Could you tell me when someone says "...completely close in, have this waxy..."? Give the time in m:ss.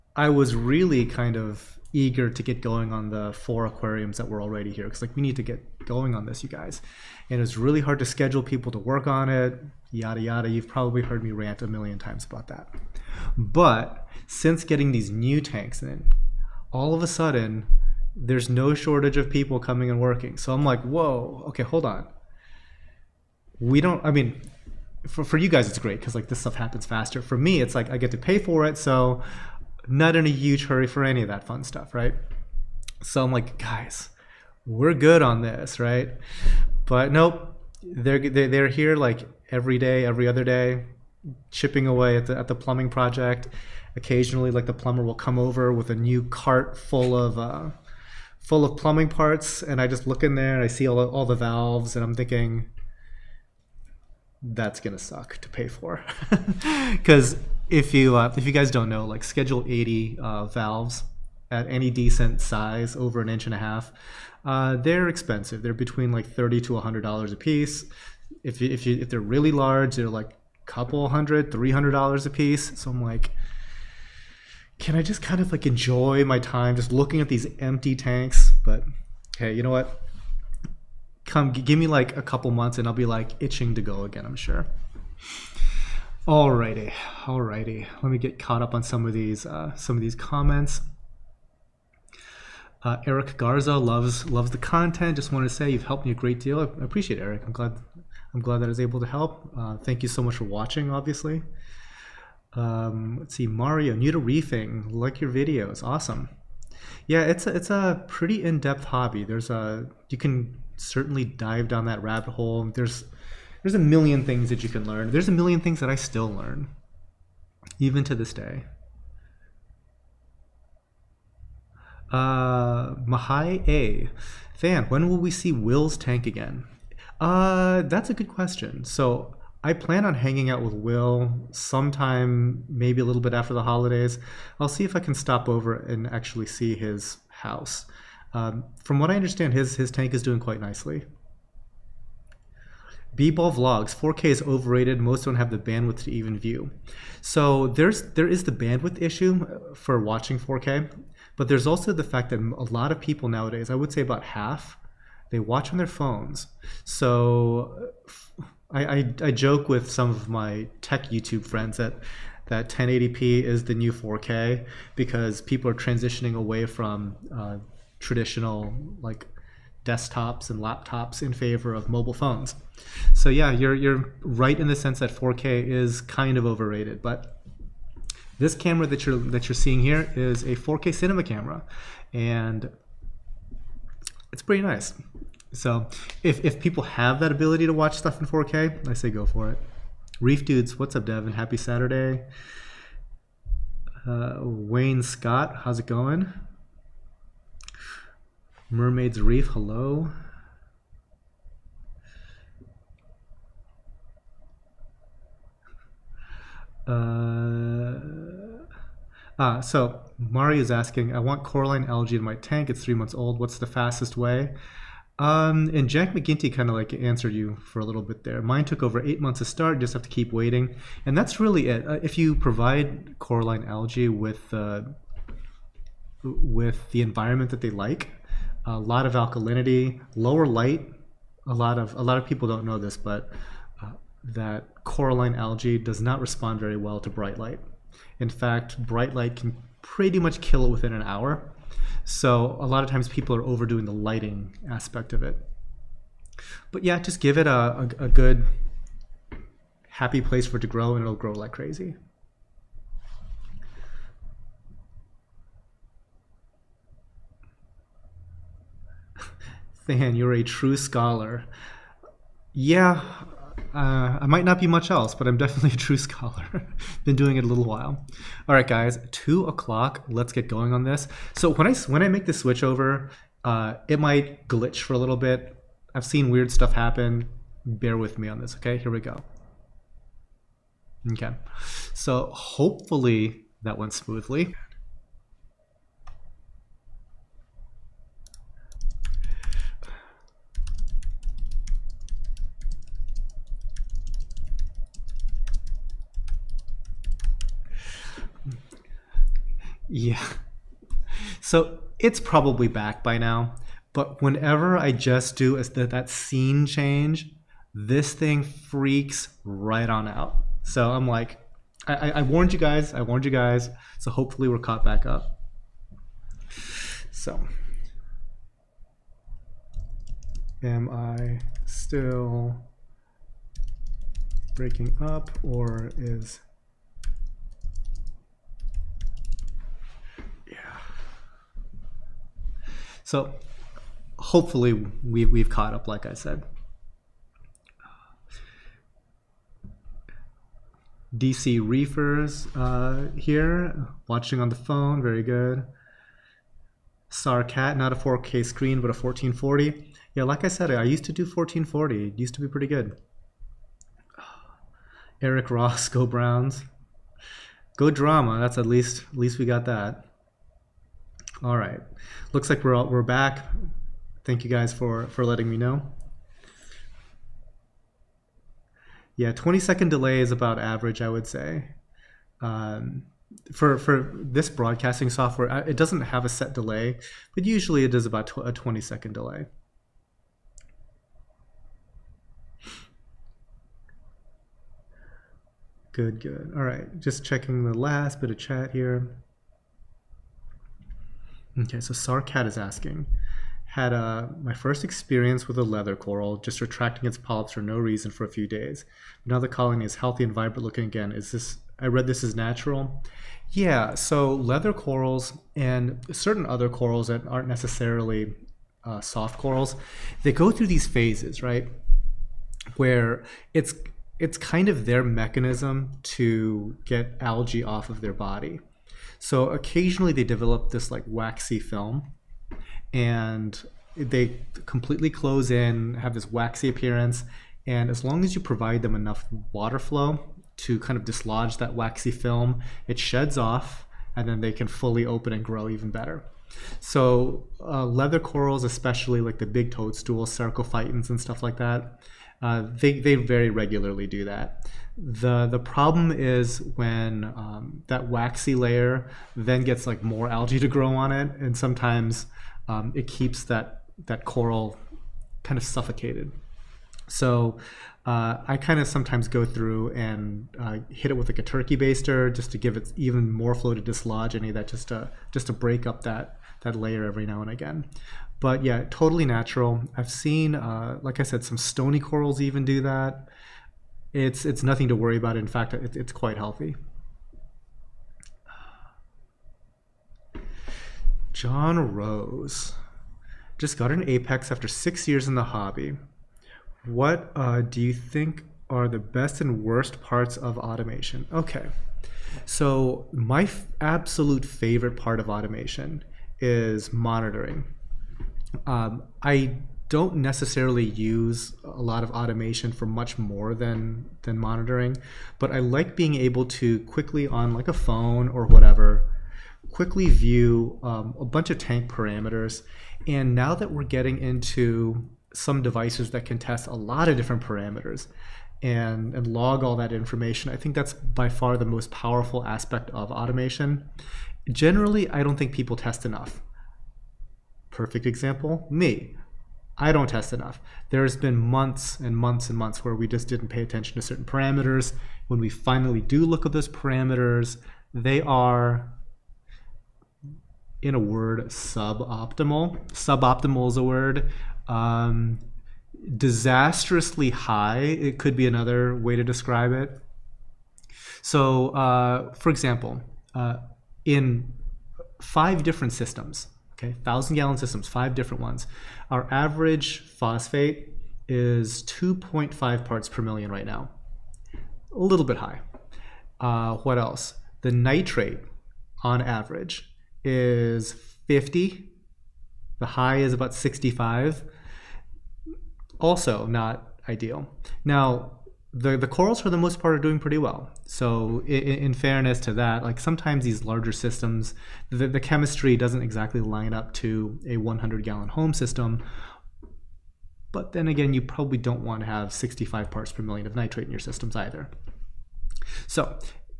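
7:04.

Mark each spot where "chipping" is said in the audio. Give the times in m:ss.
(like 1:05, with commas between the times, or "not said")
0:41.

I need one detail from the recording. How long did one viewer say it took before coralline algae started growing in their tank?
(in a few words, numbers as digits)
Over eight months.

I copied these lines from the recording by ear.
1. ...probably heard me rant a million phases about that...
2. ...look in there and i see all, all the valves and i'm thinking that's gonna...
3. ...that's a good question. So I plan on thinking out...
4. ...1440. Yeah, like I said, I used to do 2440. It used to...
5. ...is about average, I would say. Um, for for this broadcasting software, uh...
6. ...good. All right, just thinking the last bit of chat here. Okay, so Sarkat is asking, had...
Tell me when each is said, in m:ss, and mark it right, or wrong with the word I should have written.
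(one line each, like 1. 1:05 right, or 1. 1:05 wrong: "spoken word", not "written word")
1. 0:10 wrong: "times", not "phases"
2. 0:50 right
3. 2:07 wrong: "hanging", not "thinking"
4. 5:48 wrong: "1440", not "2440"
5. 6:10 right
6. 6:26 wrong: "checking", not "thinking".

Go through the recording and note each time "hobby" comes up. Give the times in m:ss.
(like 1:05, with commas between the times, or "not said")
1:48, 8:05.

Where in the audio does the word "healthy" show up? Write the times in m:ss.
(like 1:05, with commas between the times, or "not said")
6:39, 7:56.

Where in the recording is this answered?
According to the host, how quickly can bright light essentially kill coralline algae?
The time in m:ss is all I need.
4:00.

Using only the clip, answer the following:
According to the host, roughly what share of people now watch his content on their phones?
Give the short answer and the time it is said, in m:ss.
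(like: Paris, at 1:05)
About half, at 2:34.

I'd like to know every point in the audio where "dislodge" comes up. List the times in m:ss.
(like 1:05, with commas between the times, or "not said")
7:11, 7:43.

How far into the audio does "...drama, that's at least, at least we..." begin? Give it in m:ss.
5:57.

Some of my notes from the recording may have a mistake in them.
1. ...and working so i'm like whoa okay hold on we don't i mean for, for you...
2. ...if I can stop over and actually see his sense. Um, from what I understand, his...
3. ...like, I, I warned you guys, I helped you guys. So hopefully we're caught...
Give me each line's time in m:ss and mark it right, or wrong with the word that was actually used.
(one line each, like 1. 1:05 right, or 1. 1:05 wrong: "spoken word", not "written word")
1. 0:19 right
2. 2:14 wrong: "house", not "sense"
3. 5:11 wrong: "warned", not "helped".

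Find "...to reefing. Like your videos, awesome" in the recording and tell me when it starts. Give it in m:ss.
1:44.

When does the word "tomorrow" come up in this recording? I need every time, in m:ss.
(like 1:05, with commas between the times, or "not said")
not said.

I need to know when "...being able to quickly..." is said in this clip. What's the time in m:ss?
8:25.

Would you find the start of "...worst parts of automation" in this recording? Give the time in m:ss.
8:09.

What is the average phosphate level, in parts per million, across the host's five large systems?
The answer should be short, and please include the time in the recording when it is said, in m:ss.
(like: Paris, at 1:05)
2.5, at 9:21.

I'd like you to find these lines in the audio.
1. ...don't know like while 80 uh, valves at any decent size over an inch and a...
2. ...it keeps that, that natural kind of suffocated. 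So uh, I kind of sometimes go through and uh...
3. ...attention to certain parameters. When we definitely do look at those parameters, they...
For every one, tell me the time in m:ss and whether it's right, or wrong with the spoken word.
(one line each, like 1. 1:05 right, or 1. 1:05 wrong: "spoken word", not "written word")
1. 0:58 wrong: "schedule", not "while"
2. 7:32 wrong: "coral", not "natural"
3. 8:53 wrong: "finally", not "definitely".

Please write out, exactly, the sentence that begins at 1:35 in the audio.
Just want to say you've helped me a great deal.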